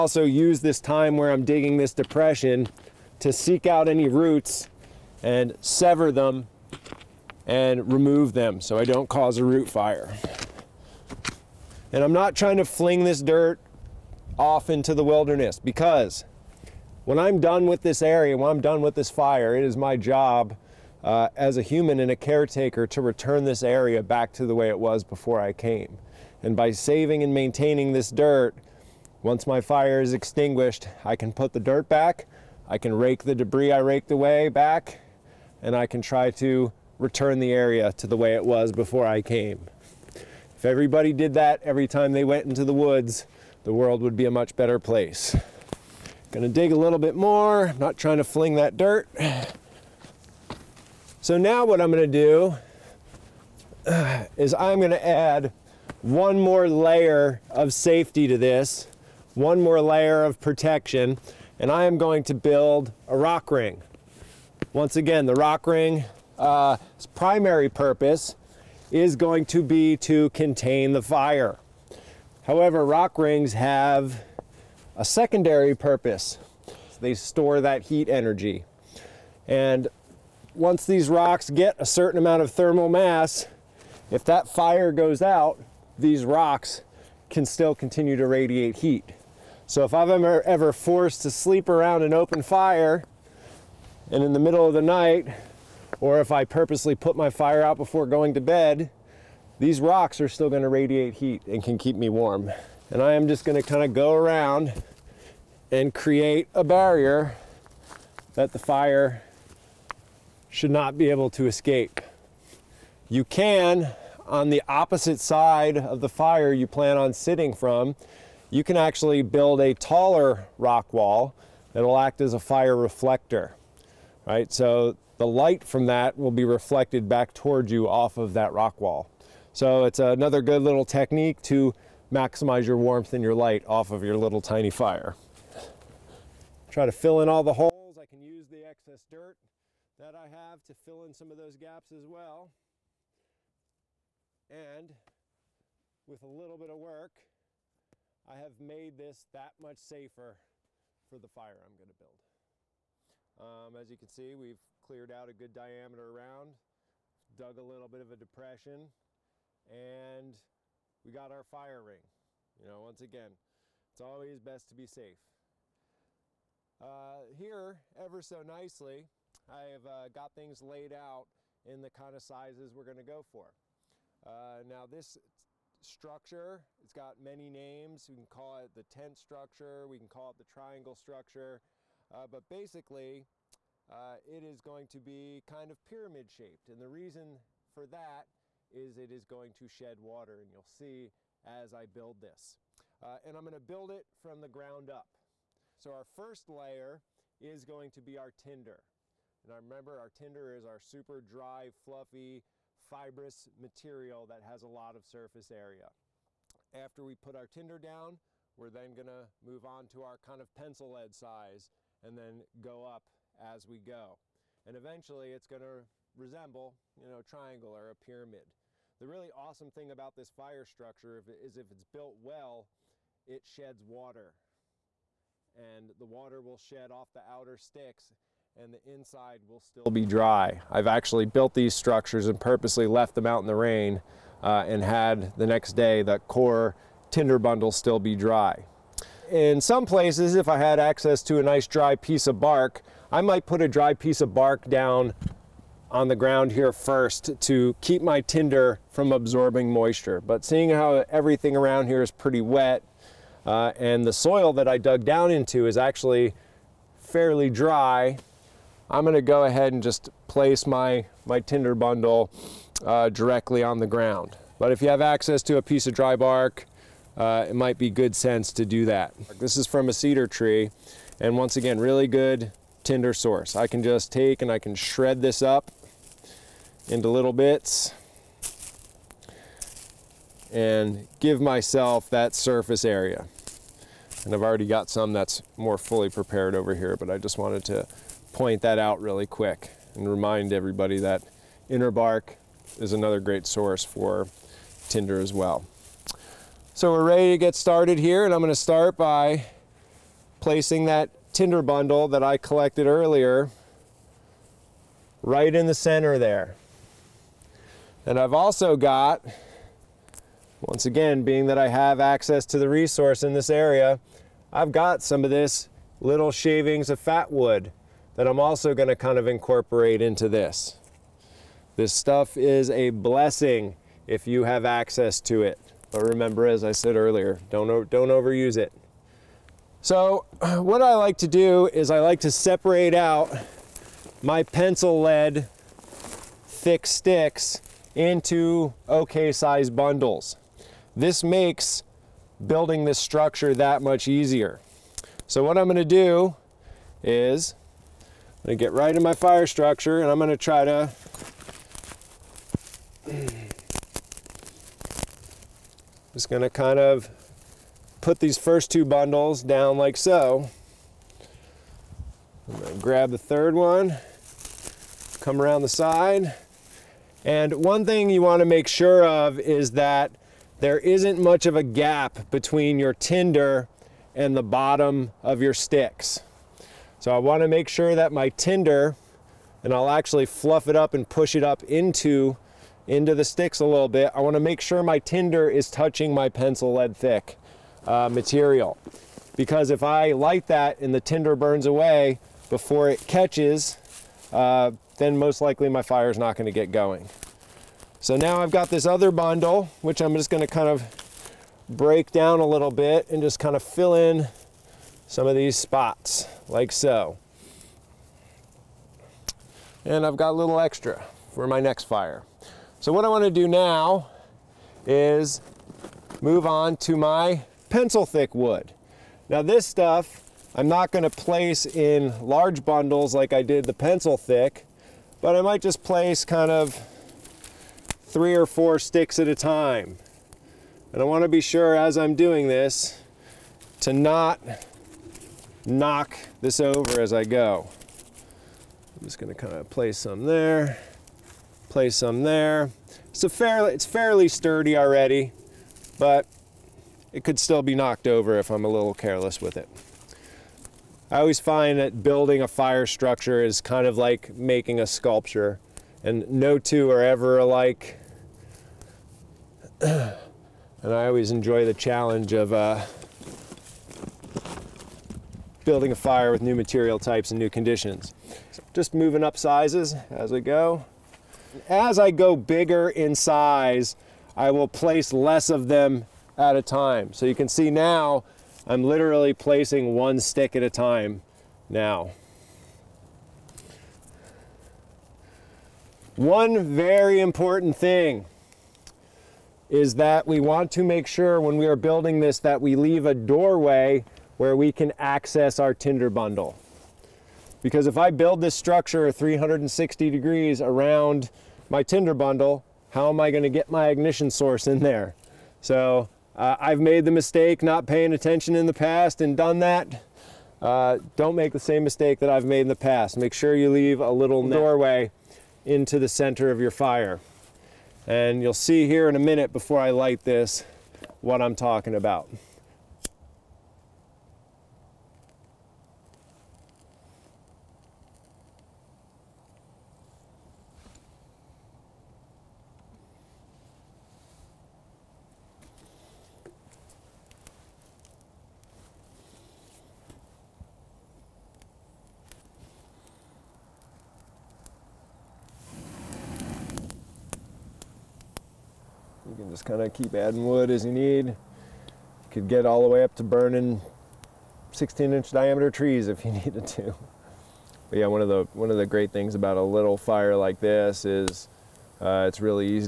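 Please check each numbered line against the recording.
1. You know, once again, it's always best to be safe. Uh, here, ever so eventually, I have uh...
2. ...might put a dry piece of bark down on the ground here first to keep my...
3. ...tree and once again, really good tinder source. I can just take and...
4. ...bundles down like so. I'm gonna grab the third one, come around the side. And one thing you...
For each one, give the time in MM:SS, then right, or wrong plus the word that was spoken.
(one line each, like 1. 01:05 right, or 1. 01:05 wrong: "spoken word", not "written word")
1. 02:42 wrong: "nicely", not "eventually"
2. 04:03 right
3. 04:30 right
4. 05:58 right.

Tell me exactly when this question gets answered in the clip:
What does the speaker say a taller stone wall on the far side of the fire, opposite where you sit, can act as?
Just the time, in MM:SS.
02:02.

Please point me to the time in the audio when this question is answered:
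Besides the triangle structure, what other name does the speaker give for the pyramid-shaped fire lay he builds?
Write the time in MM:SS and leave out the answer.
02:58.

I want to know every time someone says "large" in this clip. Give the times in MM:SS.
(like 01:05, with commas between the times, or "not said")
07:02.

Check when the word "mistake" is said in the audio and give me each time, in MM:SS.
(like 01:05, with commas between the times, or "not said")
08:27, 08:31.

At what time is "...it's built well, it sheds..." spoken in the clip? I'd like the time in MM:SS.
03:41.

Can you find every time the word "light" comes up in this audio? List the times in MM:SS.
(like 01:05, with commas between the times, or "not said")
02:05, 02:13, 06:30, 08:39.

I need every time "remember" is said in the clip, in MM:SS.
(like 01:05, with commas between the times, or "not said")
03:19, 05:26.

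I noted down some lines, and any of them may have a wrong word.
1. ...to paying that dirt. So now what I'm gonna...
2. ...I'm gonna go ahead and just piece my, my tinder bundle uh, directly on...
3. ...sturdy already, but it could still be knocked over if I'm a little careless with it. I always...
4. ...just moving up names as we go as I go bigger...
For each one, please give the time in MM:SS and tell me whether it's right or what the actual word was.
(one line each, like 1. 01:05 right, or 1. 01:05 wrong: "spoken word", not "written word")
1. 00:48 wrong: "fling", not "paying"
2. 04:18 wrong: "place", not "piece"
3. 07:24 right
4. 07:48 wrong: "sizes", not "names".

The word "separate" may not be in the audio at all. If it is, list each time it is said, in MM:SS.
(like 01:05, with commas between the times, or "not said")
05:32.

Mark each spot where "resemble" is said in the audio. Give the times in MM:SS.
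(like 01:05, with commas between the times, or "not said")
03:36.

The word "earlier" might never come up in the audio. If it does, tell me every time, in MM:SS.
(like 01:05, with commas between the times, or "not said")
05:02, 05:26.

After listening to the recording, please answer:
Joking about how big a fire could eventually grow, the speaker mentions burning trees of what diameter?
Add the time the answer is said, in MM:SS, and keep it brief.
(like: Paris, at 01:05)
16 inches, at 09:14.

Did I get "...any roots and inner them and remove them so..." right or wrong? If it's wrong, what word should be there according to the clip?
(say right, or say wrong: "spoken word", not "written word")
wrong: "sever", not "inner".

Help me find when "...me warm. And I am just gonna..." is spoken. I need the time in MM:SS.
01:41.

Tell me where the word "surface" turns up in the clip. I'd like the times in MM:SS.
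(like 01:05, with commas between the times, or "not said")
03:25, 04:42.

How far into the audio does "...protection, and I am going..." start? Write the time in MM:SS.
01:00.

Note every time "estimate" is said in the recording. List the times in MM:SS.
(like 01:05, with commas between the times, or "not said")
not said.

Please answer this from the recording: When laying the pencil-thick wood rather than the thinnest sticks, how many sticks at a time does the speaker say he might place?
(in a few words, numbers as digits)
3 or 4.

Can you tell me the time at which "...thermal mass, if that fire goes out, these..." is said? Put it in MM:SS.
01:22.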